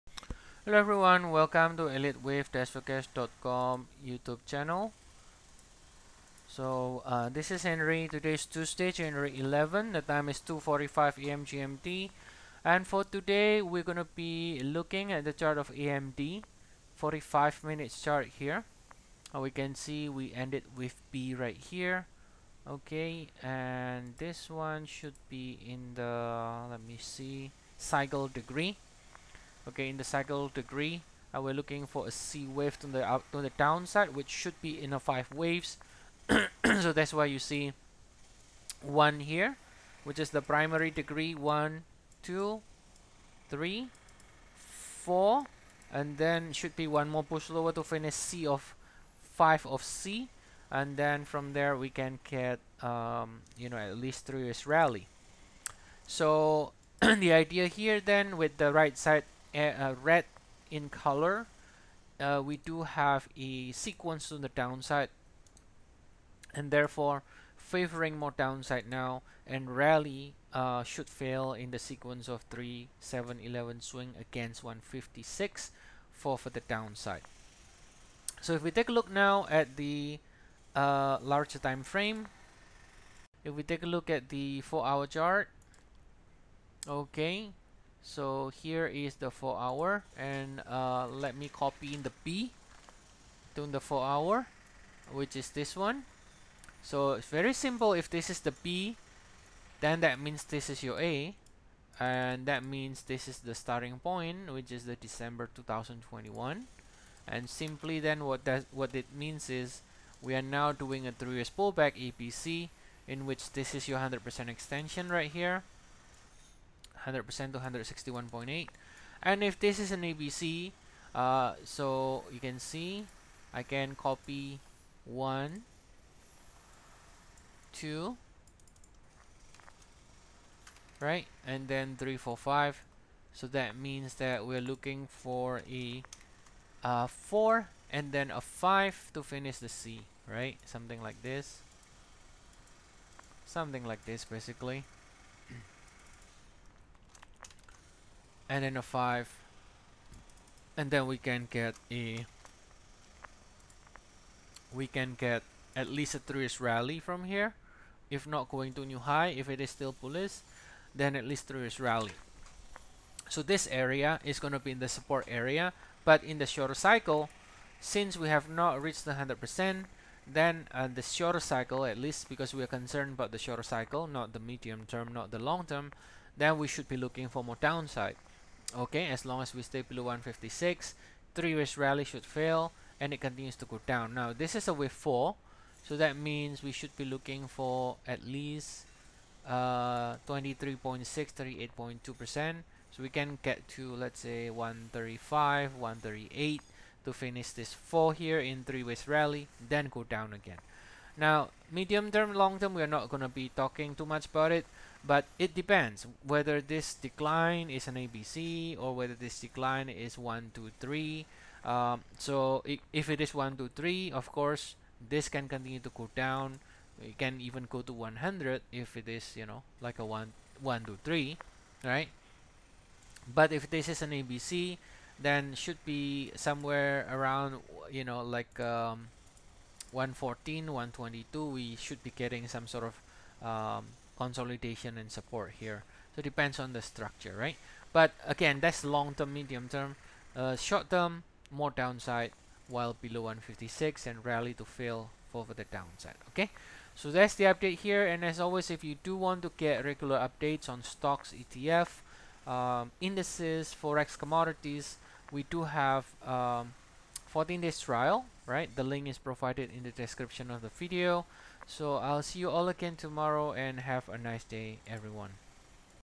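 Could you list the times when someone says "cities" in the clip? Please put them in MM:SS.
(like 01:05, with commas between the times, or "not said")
not said.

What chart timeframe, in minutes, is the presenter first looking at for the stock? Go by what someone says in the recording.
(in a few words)
45 minutes.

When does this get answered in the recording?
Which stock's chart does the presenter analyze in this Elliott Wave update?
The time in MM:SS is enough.
00:15.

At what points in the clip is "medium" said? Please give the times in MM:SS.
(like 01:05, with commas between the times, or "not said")
02:54, 03:21, 03:59.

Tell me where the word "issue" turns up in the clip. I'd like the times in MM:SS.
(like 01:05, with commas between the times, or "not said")
not said.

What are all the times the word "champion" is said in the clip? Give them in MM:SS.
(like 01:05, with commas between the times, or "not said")
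not said.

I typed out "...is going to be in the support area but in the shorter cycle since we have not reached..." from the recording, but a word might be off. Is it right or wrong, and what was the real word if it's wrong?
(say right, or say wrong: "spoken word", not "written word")
right.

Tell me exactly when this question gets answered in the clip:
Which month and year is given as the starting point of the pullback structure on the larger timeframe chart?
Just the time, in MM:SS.
01:44.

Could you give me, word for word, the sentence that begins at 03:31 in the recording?
Um, so if it is 1, 2, 3, of course, this can continue to cool down.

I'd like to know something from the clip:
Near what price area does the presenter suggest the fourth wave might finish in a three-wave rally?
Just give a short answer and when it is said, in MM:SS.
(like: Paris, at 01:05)
135 to 138, at 03:14.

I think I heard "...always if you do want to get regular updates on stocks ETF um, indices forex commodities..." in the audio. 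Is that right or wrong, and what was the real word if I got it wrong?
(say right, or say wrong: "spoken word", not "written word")
right.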